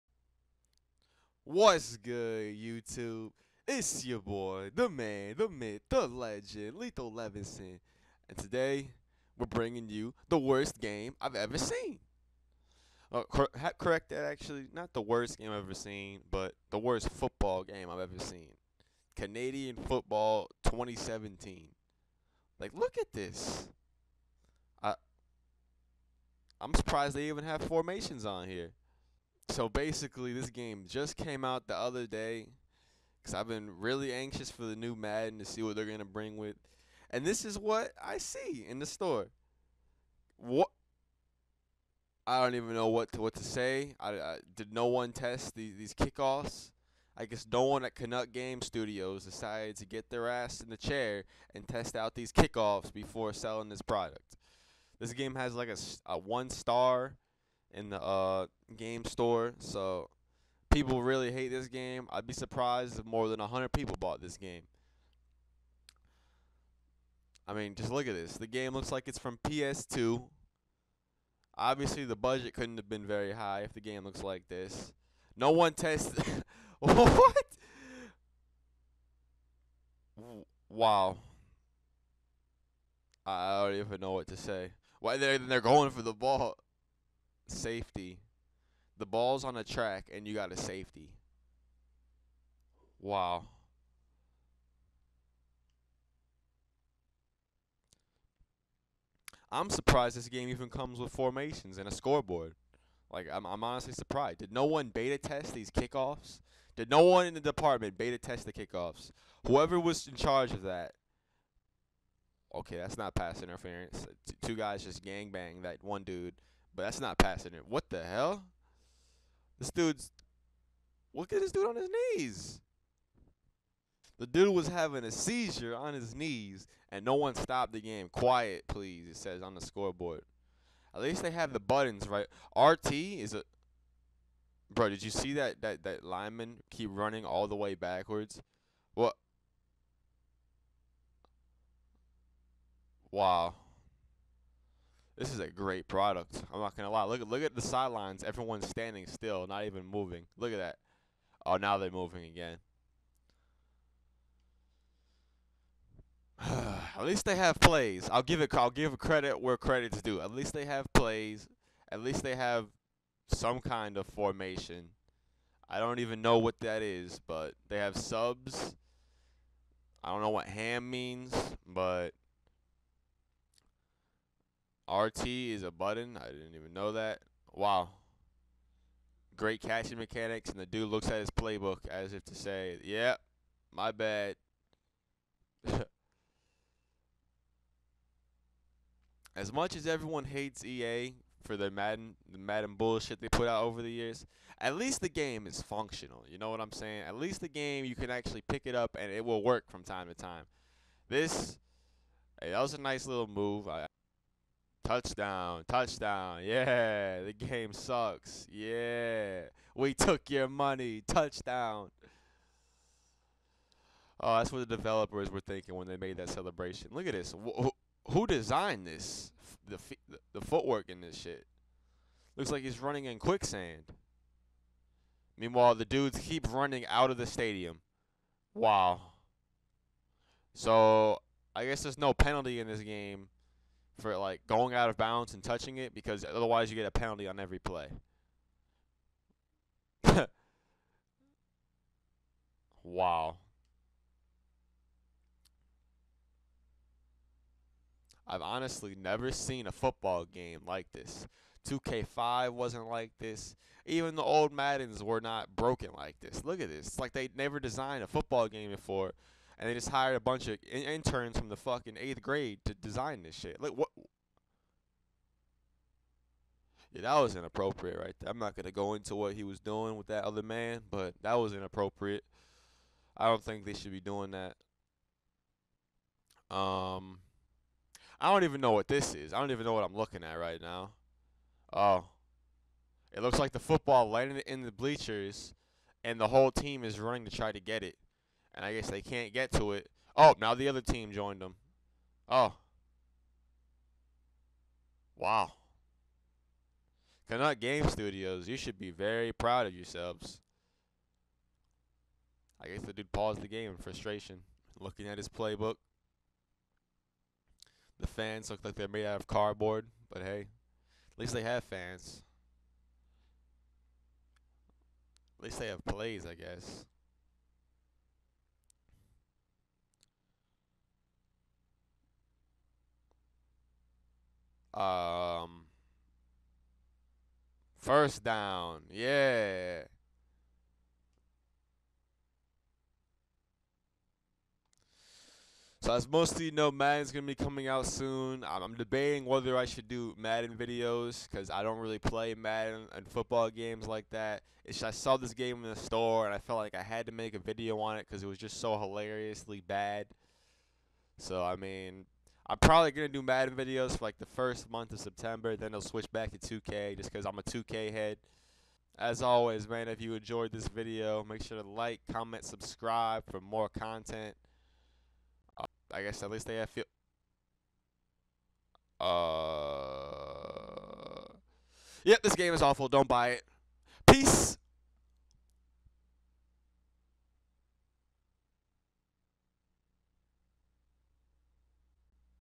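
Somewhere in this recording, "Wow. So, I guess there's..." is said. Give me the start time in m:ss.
3:48.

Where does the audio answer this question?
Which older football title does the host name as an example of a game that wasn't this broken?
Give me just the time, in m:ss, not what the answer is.
4:11.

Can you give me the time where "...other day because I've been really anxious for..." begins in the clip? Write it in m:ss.
0:31.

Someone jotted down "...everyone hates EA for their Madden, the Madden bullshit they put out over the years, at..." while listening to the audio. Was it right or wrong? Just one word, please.
right.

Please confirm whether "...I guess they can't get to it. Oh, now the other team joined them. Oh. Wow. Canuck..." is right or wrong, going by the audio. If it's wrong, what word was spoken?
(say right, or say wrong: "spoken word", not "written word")
right.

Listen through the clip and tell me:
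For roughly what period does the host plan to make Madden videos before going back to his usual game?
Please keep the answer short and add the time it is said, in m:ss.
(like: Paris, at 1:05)
first month of September, at 5:54.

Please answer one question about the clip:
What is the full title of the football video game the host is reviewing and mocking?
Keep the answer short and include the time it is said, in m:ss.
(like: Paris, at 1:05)
Canadian Football 2017, at 0:19.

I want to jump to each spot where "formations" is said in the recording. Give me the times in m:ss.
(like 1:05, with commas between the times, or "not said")
0:27, 1:41, 2:44.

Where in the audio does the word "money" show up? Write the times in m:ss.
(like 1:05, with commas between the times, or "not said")
3:30.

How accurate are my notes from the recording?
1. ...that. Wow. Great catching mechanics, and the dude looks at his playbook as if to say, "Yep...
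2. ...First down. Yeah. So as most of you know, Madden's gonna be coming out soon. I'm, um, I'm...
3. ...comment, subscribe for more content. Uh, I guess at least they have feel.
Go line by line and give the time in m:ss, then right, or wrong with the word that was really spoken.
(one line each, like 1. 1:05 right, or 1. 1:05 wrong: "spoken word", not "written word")
1. 2:56 right
2. 5:27 right
3. 6:02 right.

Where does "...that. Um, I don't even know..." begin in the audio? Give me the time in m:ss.
4:34.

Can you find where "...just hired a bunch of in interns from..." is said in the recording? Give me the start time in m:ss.
4:19.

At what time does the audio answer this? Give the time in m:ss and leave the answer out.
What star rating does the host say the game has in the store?
0:56.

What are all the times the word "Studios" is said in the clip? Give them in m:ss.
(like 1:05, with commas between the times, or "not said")
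0:48, 4:57.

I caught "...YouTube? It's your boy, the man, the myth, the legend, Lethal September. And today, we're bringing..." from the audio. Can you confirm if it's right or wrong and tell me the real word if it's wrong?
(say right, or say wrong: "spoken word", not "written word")
wrong: "Levinson", not "September".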